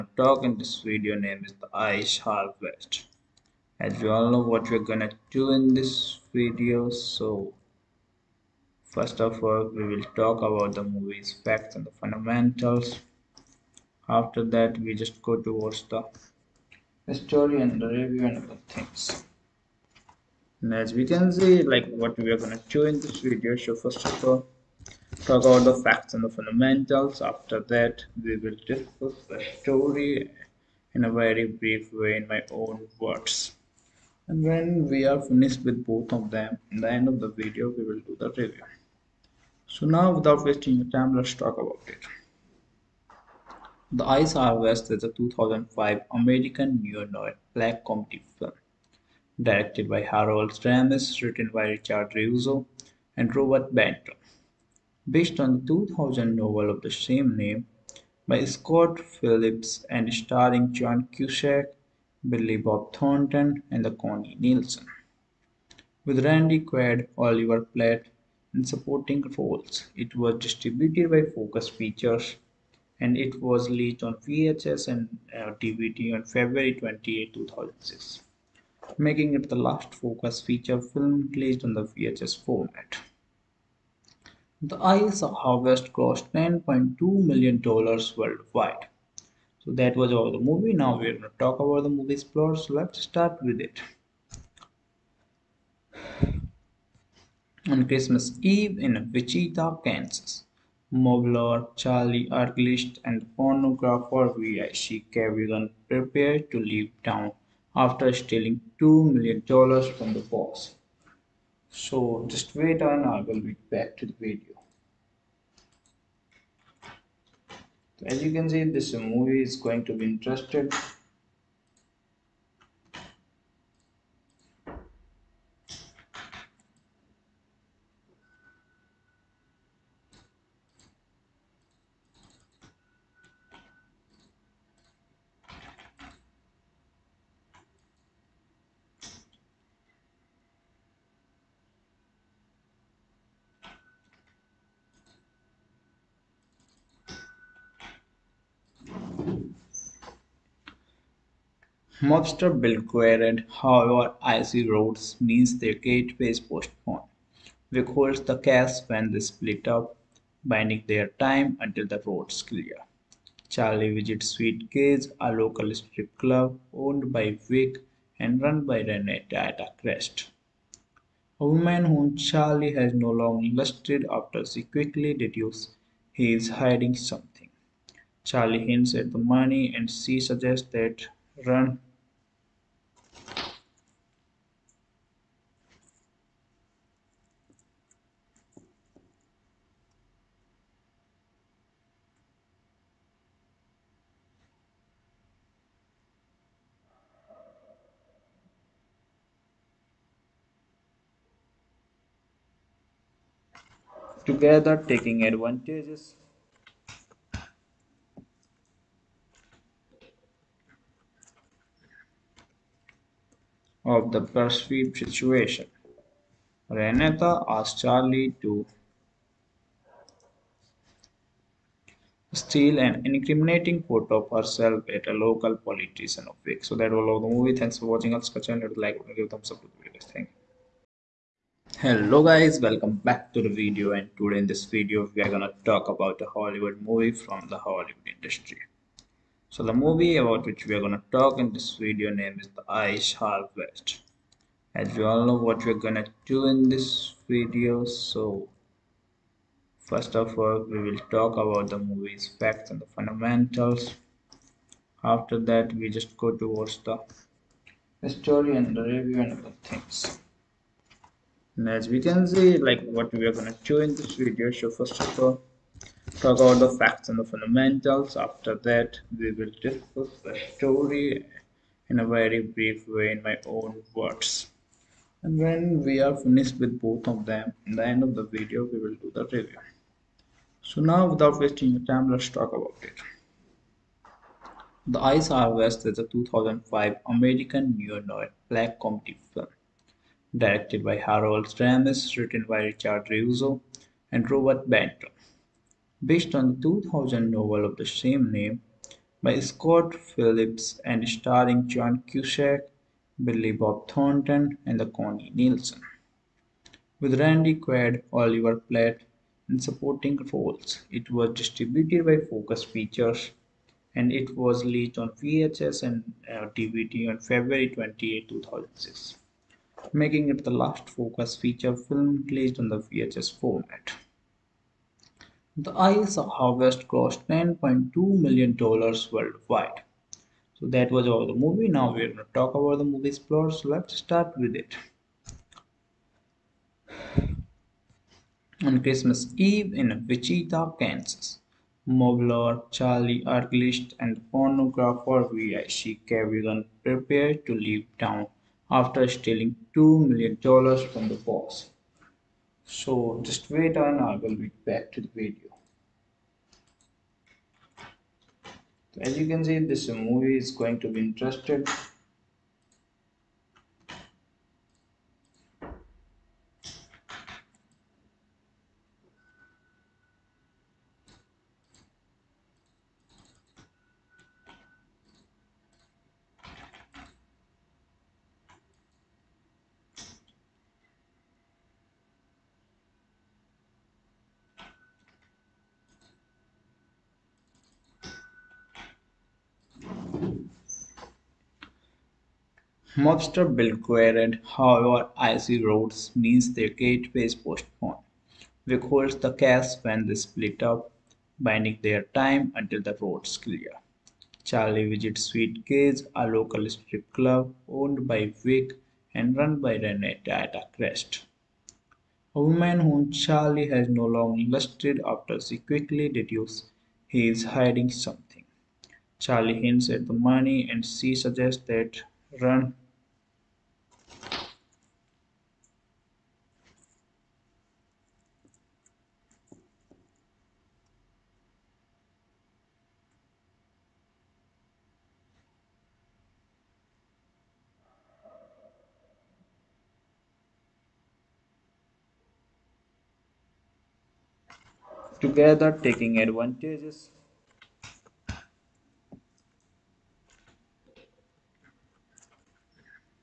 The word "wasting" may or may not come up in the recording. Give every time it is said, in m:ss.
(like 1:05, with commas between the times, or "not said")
0:40, 4:41.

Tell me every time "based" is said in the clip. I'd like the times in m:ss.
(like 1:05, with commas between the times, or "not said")
0:55, 4:56.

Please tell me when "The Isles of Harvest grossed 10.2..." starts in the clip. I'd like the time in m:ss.
5:25.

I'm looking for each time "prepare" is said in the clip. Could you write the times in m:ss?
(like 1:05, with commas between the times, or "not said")
1:45, 5:46.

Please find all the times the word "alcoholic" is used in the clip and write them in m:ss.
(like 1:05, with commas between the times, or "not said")
not said.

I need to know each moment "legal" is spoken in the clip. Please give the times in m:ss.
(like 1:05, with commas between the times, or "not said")
not said.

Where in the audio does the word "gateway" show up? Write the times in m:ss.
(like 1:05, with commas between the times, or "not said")
2:35, 6:36.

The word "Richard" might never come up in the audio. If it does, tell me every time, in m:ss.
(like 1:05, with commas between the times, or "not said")
0:51, 4:52.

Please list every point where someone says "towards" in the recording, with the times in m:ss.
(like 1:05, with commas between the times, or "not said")
0:15, 4:16.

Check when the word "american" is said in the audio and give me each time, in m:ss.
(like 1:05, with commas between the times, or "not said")
0:46, 4:47.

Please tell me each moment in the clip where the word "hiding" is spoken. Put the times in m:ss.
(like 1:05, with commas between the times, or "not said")
2:56, 6:57.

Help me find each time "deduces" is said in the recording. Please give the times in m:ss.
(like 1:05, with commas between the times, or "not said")
2:55, 6:56.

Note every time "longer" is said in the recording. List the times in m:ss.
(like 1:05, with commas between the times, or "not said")
2:53, 6:54.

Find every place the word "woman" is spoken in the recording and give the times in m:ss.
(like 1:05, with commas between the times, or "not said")
2:51, 6:52.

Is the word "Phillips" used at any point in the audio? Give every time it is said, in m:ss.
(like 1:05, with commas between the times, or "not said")
0:58, 4:59.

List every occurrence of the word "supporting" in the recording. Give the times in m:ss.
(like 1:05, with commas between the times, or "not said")
1:08, 5:09.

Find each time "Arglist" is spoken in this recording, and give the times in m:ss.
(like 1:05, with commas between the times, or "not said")
1:42, 5:43.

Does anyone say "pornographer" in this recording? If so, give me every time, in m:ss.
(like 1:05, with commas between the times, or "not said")
1:43, 5:44.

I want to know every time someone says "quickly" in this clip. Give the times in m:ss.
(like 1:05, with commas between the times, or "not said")
2:54, 6:55.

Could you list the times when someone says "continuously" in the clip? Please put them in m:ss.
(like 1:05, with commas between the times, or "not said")
not said.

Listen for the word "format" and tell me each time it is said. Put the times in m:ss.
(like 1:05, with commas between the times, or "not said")
1:22, 5:23.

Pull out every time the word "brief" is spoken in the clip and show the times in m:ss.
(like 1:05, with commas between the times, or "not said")
0:31, 4:32.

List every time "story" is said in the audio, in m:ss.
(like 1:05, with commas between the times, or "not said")
0:17, 0:29, 4:18, 4:30.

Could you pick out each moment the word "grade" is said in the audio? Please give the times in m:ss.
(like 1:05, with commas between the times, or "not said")
not said.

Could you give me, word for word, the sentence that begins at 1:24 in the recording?
The of harvest cost 10.2 million dollars worldwide.